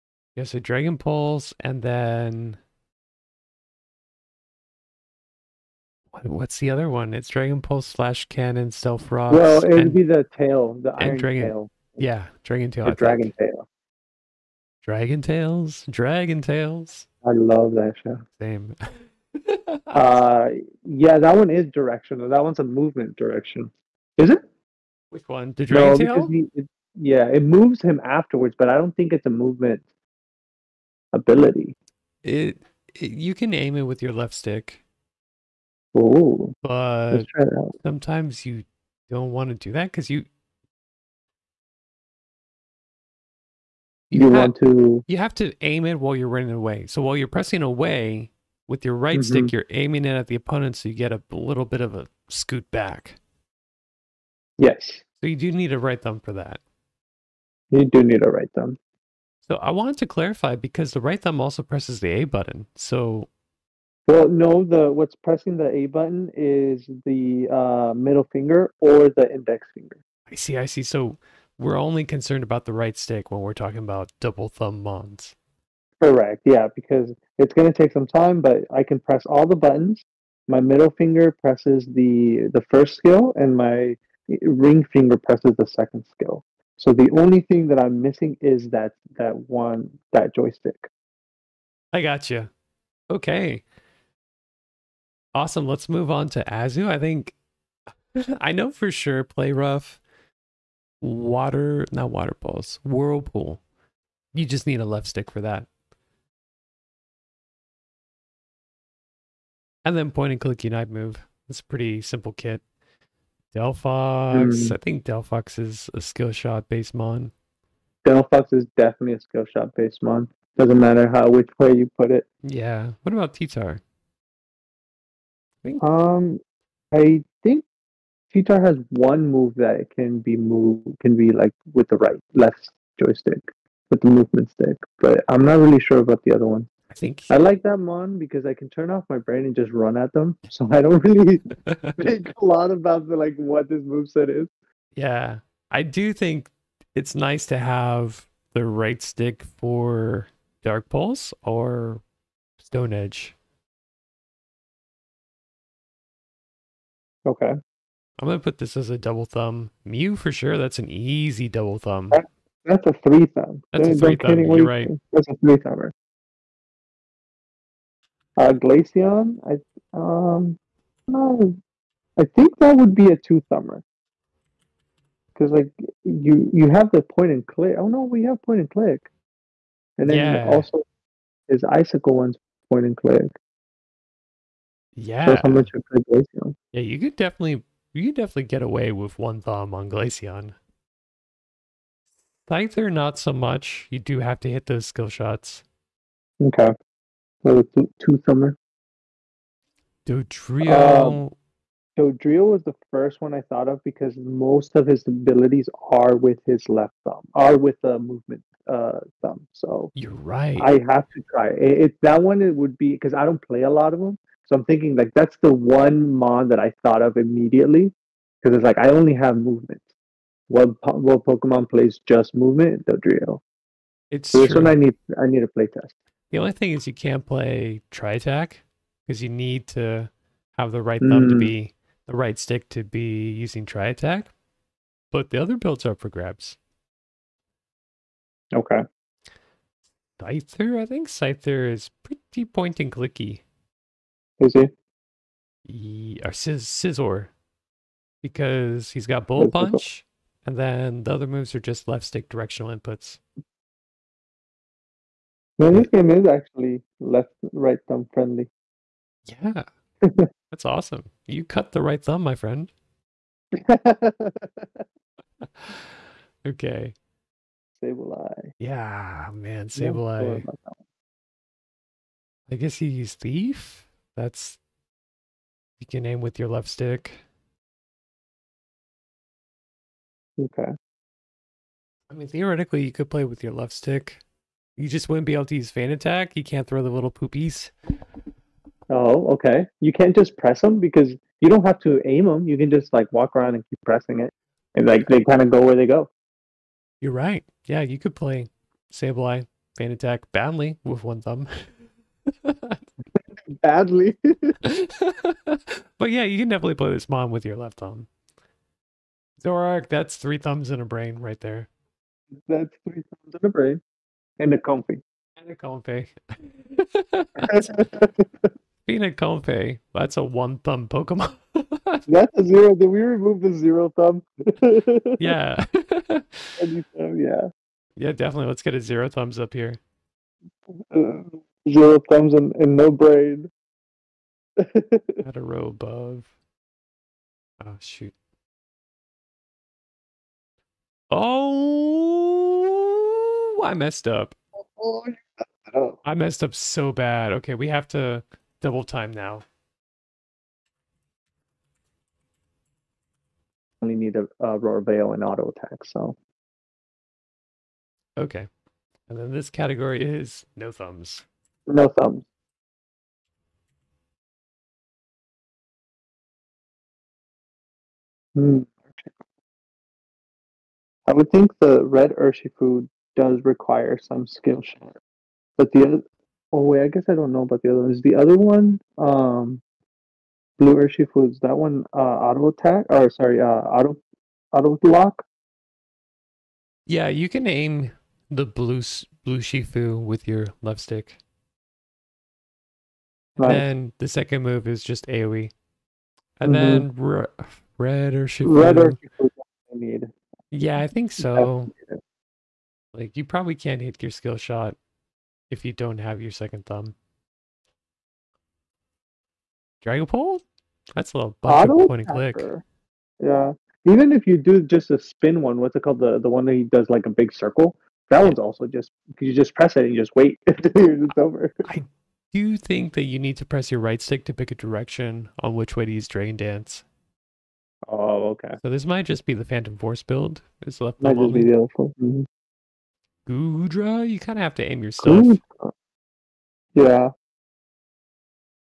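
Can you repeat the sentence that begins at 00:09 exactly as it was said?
Well, it'd be the tail, the iron dragon, tail.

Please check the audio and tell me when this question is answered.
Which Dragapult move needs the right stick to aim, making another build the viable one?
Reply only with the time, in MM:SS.
07:06.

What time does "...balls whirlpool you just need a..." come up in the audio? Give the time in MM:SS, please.
01:42.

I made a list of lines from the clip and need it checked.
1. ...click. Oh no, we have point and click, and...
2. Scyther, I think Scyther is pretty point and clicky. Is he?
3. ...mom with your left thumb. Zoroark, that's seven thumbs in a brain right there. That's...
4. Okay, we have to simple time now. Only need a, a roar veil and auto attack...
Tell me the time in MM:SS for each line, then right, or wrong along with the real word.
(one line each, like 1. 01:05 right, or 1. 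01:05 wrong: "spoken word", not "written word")
1. 02:57 right
2. 04:00 right
3. 05:07 wrong: "three", not "seven"
4. 05:47 wrong: "double", not "simple".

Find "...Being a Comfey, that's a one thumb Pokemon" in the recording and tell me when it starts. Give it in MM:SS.
05:18.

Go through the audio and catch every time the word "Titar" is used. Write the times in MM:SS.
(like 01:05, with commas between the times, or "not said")
02:03, 02:08.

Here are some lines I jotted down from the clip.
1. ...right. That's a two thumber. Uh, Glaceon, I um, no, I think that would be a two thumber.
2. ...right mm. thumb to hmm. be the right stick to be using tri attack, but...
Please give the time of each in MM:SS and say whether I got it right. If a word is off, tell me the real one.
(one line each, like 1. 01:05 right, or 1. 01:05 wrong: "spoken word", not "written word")
1. 02:44 wrong: "three", not "two"
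2. 03:50 right.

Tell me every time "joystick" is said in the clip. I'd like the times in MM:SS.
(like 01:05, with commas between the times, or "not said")
01:30, 02:13.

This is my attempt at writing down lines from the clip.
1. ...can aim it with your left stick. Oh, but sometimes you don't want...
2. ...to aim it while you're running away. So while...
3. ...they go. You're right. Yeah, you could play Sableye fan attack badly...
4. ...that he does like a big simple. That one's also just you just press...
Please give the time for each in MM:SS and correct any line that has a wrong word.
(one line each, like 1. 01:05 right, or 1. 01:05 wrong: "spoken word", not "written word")
1. 00:33 right
2. 00:45 right
3. 04:55 right
4. 06:56 wrong: "circle", not "simple".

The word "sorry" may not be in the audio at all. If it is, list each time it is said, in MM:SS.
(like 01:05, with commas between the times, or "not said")
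06:23.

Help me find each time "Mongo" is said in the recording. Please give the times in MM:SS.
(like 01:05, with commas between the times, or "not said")
not said.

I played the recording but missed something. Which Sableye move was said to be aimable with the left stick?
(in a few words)
Thief.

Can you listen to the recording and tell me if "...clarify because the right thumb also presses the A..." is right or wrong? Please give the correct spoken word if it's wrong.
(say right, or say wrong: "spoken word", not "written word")
right.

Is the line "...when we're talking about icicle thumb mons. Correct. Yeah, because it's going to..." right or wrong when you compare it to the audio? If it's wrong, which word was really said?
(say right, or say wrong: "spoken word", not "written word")
wrong: "double", not "icicle".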